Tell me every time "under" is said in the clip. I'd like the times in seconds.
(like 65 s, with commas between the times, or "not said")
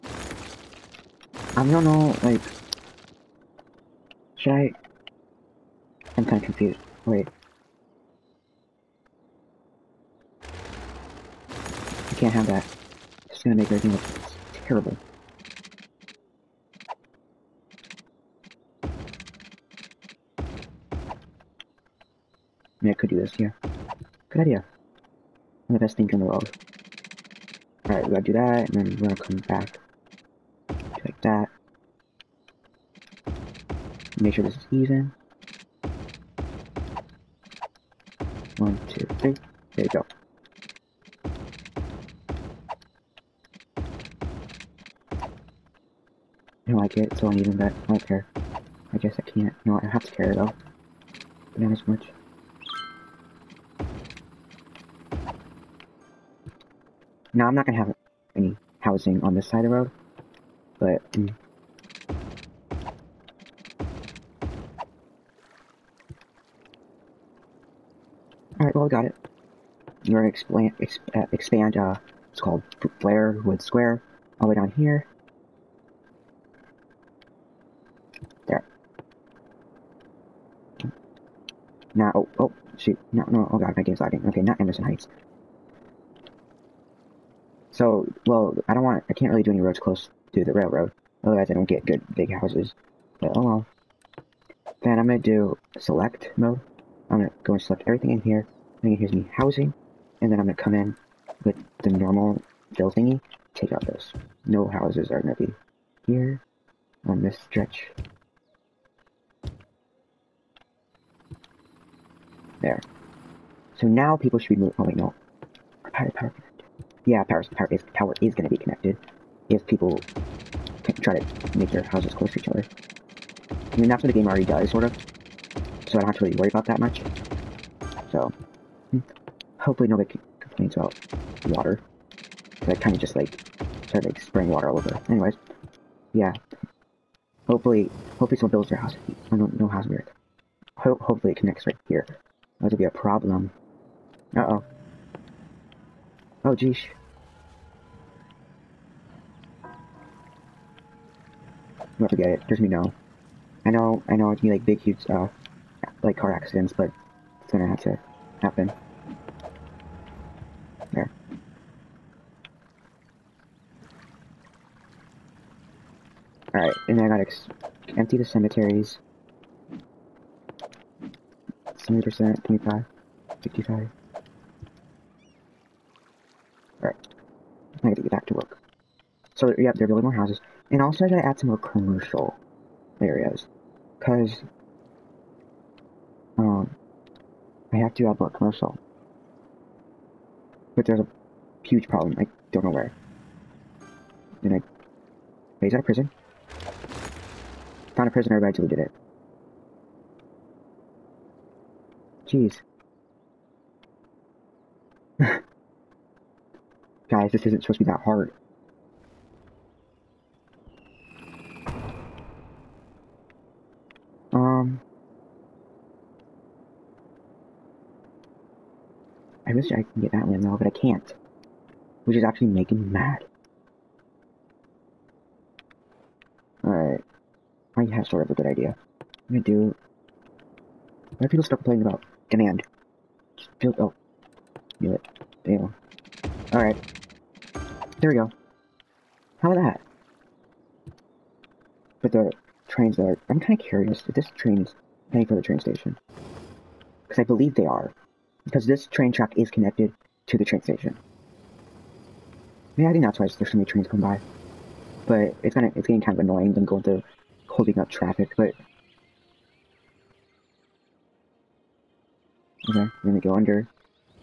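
263 s.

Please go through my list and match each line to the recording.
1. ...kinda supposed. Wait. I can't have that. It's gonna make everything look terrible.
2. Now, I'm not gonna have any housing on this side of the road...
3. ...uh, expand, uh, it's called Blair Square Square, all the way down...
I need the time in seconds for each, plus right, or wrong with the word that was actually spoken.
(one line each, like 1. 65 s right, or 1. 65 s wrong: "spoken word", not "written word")
1. 6 s wrong: "confused", not "supposed"
2. 57 s right
3. 71 s wrong: "Wood", not "Square".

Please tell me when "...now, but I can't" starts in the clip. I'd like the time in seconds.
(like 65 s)
220 s.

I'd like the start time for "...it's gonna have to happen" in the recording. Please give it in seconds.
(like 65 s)
157 s.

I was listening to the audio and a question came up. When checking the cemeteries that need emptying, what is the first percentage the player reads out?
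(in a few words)
70%.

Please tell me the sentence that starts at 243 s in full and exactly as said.
I'm kind of curious if this train is heading for the train station.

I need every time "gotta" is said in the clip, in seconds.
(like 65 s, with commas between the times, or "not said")
28 s, 167 s, 181 s.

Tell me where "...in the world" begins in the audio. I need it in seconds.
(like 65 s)
26 s.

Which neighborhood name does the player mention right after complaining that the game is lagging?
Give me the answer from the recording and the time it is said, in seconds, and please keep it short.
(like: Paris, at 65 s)
Emerson Heights, at 84 s.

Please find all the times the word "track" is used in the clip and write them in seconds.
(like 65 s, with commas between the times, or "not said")
249 s.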